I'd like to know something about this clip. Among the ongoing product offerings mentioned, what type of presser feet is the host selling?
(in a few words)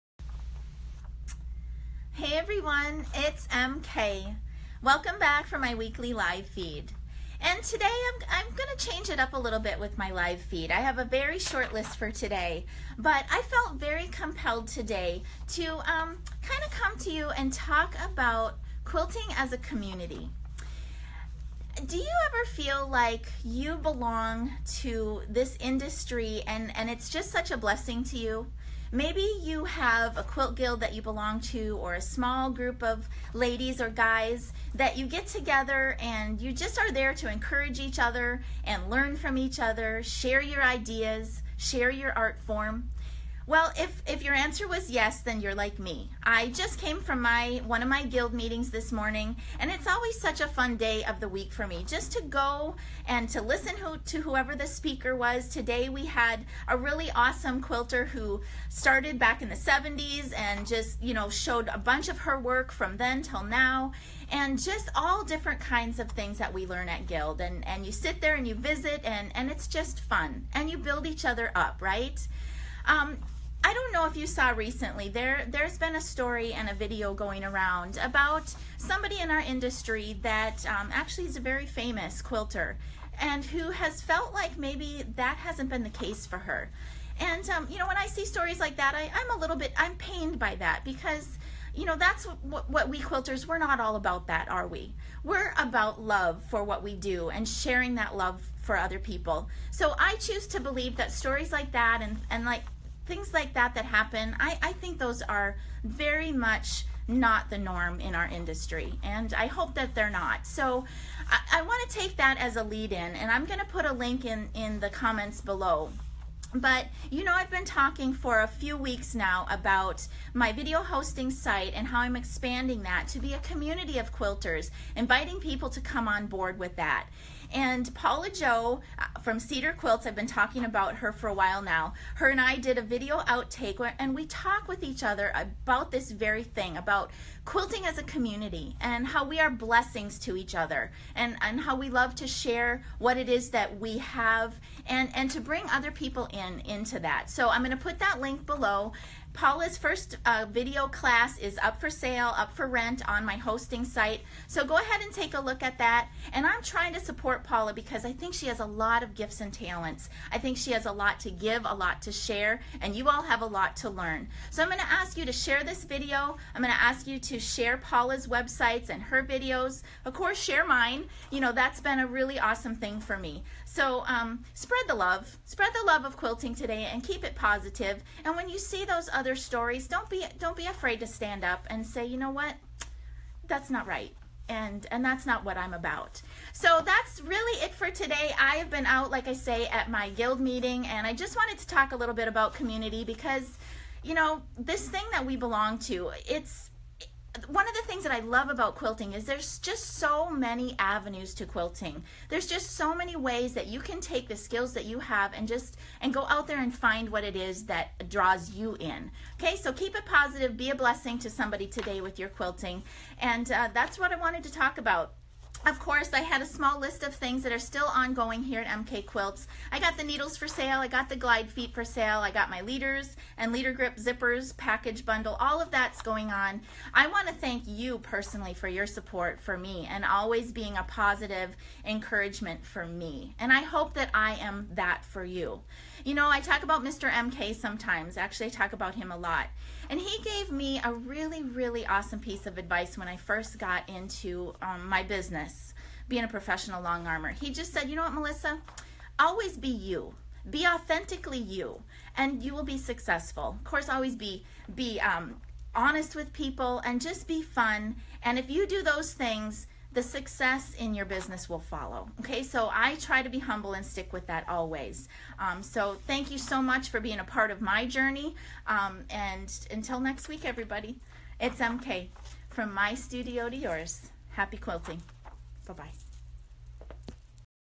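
glide feet.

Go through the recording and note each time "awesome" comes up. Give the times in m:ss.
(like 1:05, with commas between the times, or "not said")
0:57, 2:52, 4:01.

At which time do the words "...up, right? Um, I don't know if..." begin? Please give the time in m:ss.
1:11.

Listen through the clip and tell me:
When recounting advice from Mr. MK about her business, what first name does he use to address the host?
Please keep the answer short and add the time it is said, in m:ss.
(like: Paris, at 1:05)
Melissa, at 4:08.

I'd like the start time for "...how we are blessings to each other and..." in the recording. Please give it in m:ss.
2:19.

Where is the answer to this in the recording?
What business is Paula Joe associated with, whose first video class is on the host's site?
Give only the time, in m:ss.
2:09.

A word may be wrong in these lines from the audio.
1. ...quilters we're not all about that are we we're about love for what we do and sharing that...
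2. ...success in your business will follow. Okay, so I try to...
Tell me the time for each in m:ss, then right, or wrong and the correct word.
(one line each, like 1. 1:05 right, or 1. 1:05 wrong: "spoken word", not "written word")
1. 1:32 right
2. 4:20 right.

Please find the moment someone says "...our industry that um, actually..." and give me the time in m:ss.
1:19.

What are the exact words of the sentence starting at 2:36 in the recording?
And I'm trying to support Paula because I think she has a lot of gifts and talents.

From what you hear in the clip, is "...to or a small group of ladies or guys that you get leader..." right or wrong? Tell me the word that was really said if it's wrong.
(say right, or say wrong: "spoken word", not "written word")
wrong: "together", not "leader".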